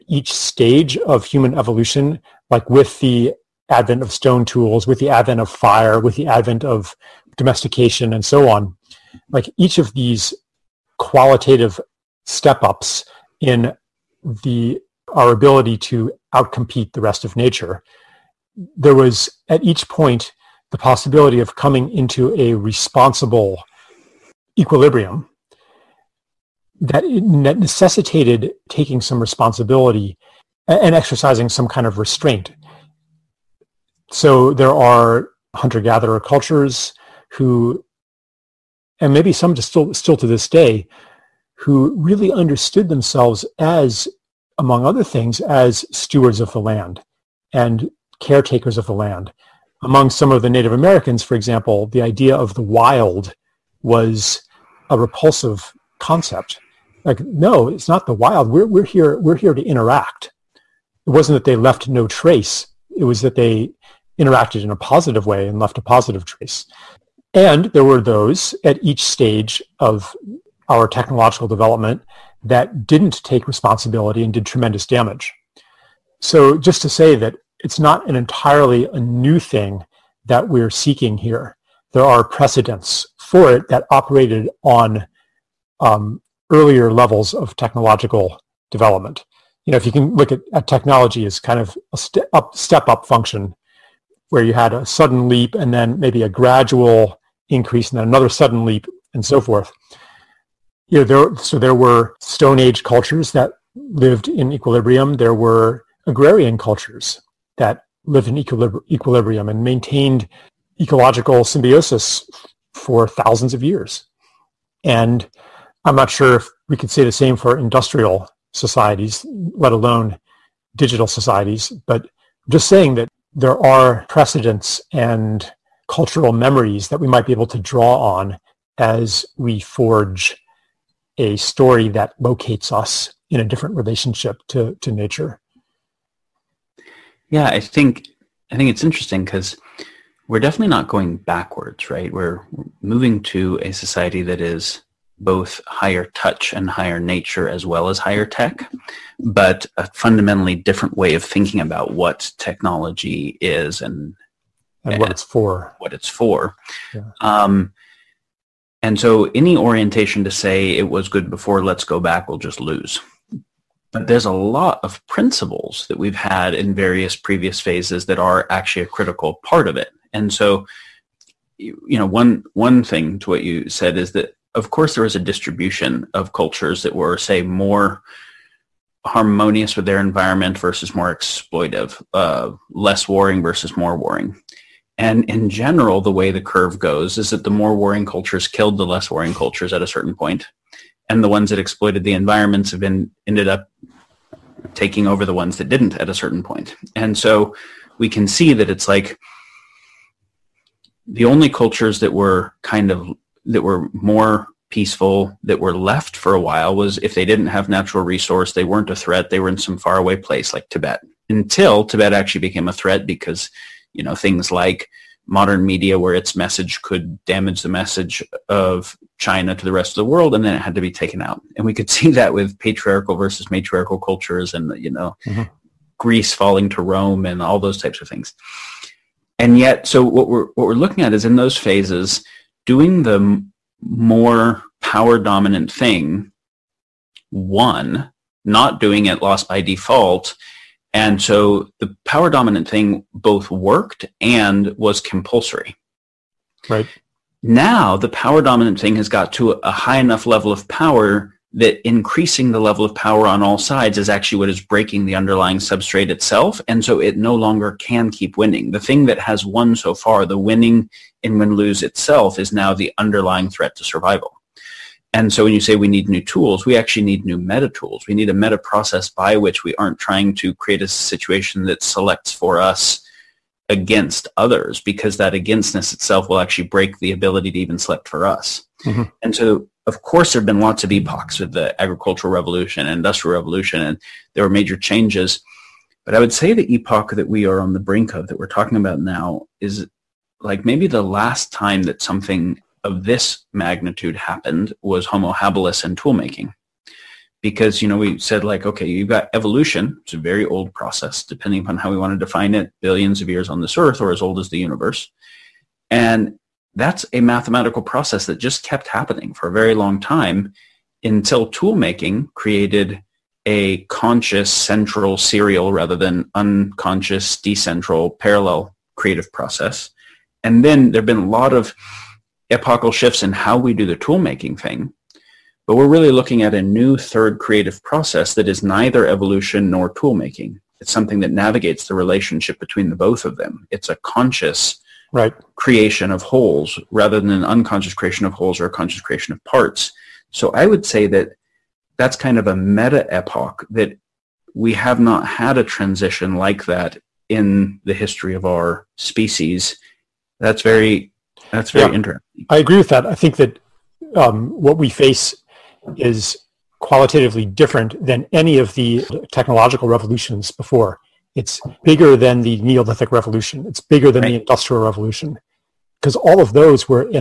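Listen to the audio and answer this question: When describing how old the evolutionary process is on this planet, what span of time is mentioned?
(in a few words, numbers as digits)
billions of years.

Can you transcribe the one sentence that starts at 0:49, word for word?
Among some of the Native Americans, for example, the idea of the wild was a repulsive concept.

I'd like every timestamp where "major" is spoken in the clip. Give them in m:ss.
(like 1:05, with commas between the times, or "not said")
4:44.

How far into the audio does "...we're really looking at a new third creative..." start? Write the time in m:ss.
5:25.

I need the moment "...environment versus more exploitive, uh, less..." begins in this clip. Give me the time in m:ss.
2:59.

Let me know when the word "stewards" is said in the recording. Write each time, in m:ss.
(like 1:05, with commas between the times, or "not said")
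0:45.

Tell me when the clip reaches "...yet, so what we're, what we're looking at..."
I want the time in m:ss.
3:49.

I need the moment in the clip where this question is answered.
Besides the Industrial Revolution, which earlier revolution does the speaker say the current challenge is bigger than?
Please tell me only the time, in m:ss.
6:02.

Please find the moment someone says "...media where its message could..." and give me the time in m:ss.
3:35.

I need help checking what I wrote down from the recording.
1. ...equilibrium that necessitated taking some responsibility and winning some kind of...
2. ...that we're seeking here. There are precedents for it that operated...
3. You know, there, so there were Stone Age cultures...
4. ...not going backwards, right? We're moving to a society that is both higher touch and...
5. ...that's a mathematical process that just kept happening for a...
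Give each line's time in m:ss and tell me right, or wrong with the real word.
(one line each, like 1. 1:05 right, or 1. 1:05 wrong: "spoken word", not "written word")
1. 0:24 wrong: "exercising", not "winning"
2. 1:20 right
3. 1:40 right
4. 2:20 right
5. 5:06 right.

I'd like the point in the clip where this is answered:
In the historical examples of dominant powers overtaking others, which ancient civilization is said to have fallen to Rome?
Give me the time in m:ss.
3:45.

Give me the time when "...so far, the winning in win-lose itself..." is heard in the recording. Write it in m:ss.
4:19.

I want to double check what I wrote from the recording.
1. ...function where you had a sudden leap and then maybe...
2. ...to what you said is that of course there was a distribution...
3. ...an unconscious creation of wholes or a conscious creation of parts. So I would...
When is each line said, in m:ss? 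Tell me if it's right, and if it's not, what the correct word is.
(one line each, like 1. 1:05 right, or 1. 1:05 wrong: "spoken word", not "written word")
1. 1:33 right
2. 2:53 right
3. 5:37 right.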